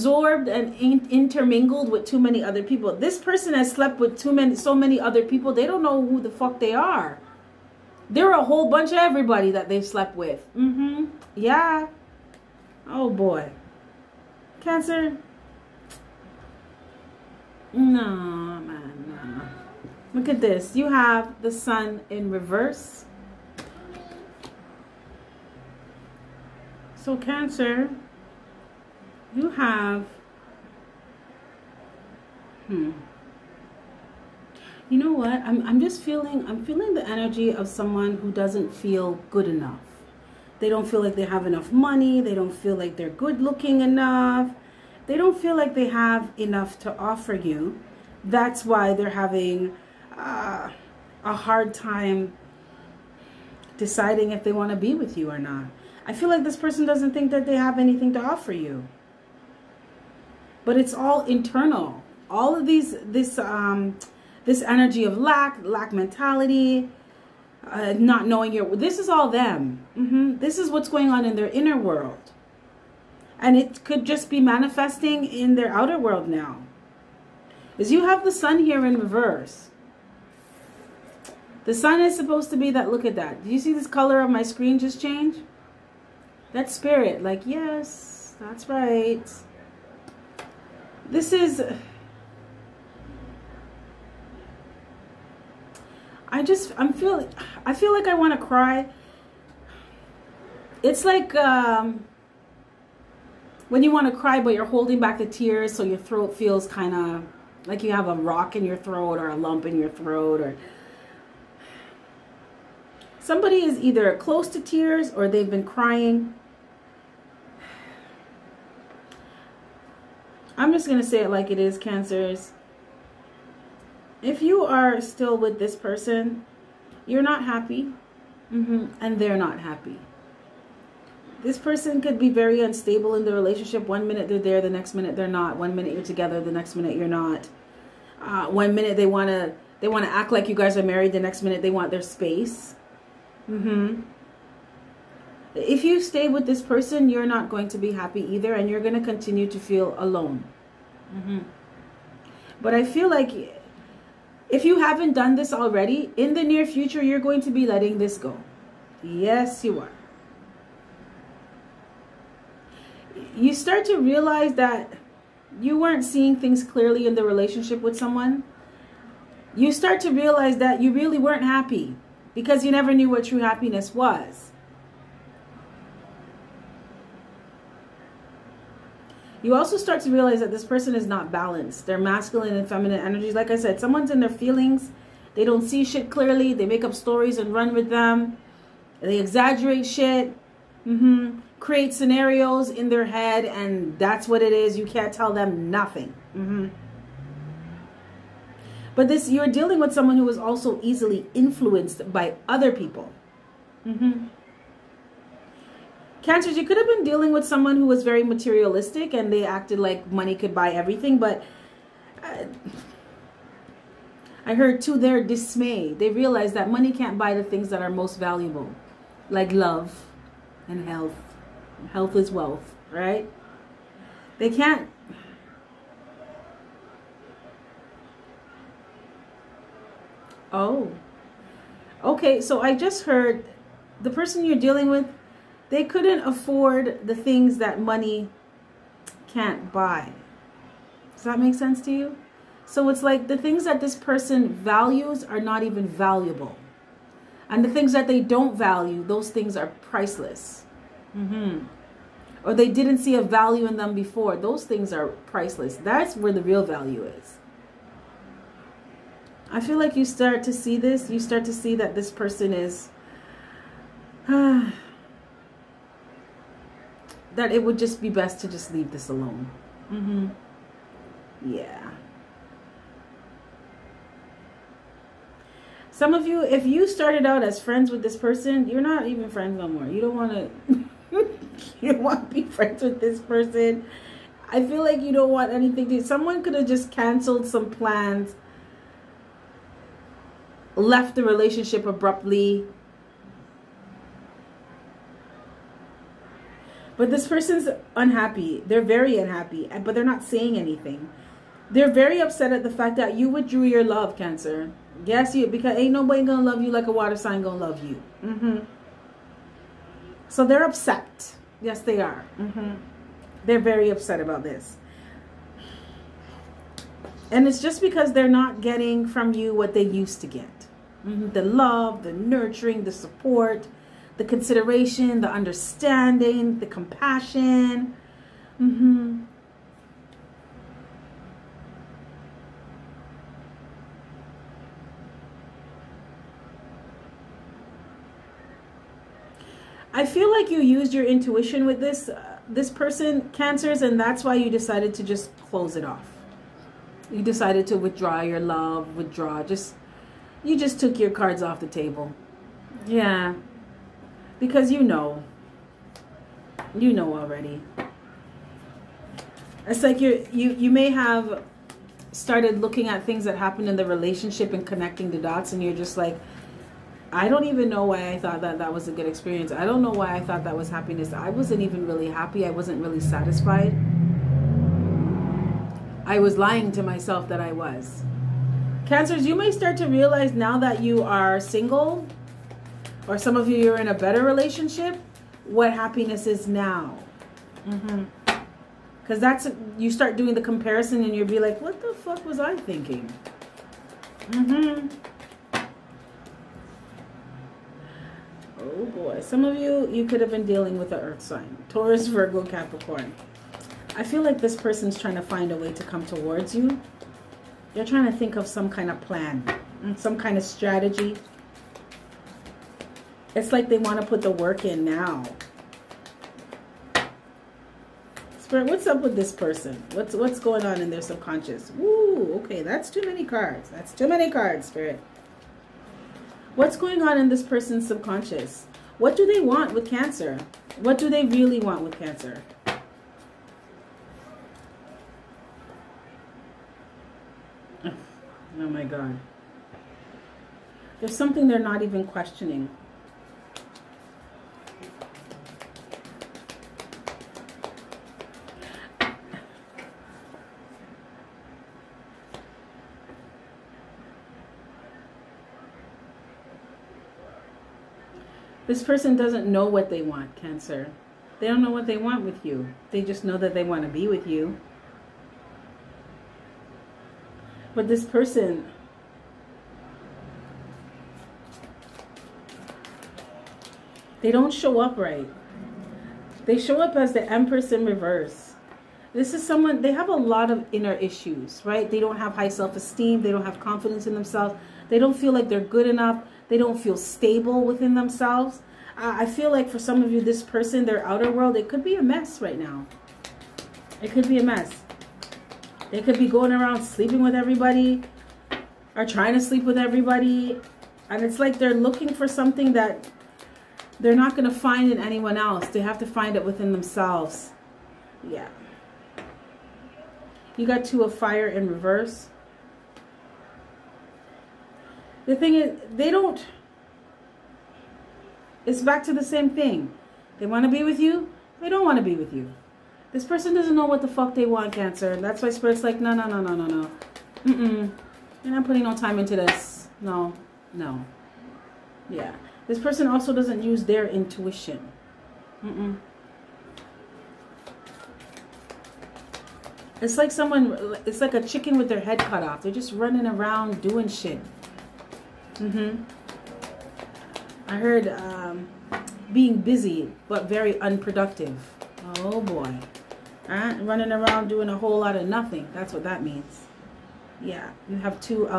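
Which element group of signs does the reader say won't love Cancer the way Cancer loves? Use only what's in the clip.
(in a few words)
Water sign.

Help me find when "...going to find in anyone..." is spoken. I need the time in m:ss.
8:24.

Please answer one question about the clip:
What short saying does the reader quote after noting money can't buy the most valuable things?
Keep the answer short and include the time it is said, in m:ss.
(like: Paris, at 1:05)
Health is wealth, at 3:41.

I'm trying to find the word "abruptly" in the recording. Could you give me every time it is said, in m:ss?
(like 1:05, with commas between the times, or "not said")
4:51.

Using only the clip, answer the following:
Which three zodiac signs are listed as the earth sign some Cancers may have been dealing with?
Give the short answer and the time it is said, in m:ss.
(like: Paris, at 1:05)
Taurus, Virgo, Capricorn, at 6:41.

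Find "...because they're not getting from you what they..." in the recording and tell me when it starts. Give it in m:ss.
5:17.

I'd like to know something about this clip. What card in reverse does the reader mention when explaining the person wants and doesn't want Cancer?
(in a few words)
Two of fire.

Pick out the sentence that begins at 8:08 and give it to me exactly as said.
I, I feel like for some of you, this person, their outer world, it could be a mess right now.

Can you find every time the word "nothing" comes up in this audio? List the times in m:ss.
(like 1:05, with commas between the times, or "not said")
3:15, 9:15.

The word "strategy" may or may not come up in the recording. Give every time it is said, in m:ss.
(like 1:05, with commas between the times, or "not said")
6:50.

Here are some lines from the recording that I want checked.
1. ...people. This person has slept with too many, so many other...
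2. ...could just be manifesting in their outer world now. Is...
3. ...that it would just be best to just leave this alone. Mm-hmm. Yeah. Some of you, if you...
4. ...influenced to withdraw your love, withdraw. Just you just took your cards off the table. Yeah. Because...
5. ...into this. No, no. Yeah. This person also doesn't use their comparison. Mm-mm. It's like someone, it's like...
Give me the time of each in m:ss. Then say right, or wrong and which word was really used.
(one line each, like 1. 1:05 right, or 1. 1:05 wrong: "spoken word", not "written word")
1. 0:02 right
2. 1:13 right
3. 4:27 right
4. 5:47 wrong: "decided", not "influenced"
5. 8:49 wrong: "intuition", not "comparison".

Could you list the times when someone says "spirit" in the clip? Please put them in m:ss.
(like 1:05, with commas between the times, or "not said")
1:26, 6:58, 7:04, 8:45.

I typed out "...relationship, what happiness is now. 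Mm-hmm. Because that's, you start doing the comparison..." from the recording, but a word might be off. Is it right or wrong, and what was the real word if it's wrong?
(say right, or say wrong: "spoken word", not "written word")
right.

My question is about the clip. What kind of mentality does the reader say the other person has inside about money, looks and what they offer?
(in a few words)
Lack mentality.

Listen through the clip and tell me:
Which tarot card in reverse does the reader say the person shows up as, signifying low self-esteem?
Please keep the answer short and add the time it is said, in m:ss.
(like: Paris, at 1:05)
The Empress, at 7:57.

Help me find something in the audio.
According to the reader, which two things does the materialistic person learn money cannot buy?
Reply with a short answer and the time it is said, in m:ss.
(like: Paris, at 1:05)
Love and health, at 3:39.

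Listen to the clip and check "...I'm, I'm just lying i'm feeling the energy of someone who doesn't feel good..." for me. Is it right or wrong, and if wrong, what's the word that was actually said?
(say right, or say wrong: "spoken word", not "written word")
wrong: "feeling", not "lying".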